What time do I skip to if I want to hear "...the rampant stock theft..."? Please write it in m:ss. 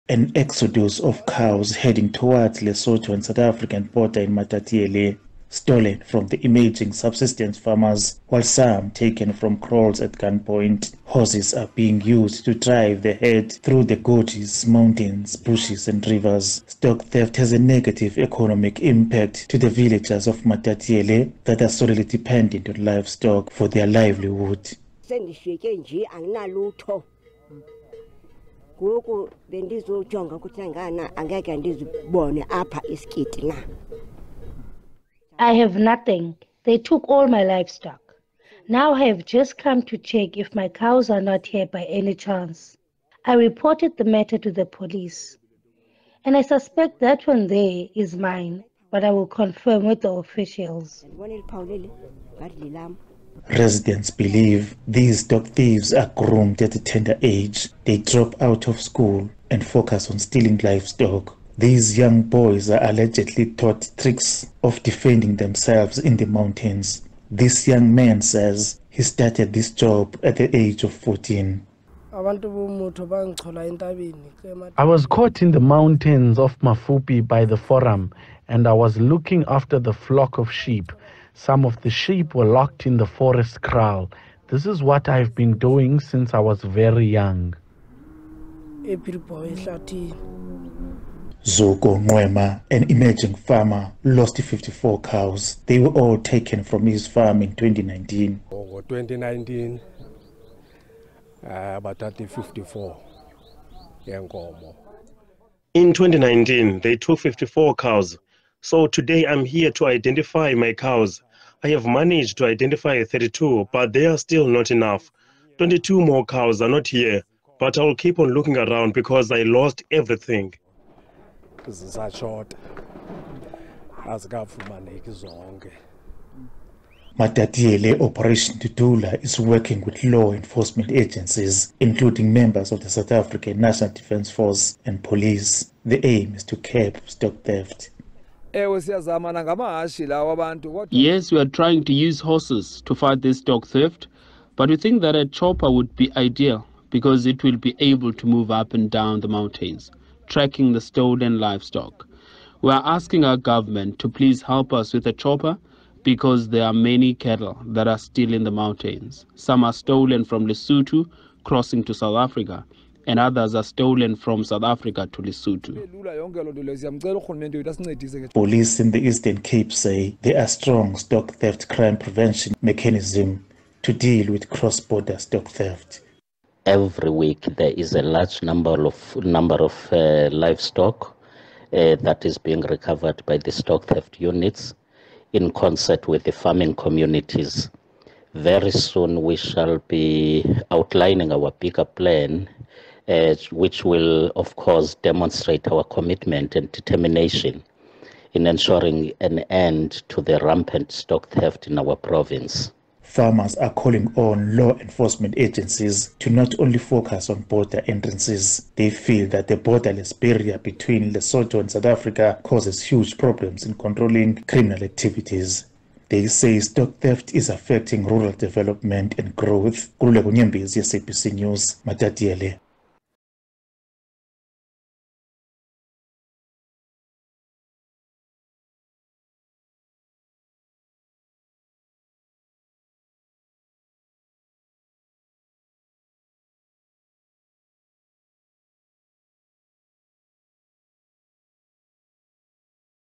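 3:20.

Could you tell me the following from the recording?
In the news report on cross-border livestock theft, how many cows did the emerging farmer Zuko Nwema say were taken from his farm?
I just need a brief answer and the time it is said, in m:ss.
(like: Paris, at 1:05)
54, at 1:34.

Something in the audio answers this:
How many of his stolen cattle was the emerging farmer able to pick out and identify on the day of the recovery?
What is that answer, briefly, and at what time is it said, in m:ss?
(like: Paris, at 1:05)
32, at 1:53.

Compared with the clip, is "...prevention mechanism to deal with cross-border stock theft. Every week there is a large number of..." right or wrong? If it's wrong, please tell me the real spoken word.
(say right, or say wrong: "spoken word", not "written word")
right.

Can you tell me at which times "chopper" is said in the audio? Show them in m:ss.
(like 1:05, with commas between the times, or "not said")
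2:25, 2:35.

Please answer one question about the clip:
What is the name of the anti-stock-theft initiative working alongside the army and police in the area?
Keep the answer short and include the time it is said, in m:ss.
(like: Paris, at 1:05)
Operation Tutula, at 2:07.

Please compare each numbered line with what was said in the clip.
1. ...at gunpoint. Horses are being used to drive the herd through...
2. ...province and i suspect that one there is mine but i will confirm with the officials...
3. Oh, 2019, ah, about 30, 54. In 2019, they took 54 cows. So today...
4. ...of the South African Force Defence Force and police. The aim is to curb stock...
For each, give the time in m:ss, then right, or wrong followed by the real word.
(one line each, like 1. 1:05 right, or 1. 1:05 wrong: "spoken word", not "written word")
1. 0:10 right
2. 0:44 wrong: "police", not "province"
3. 1:38 right
4. 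2:12 wrong: "National", not "Force".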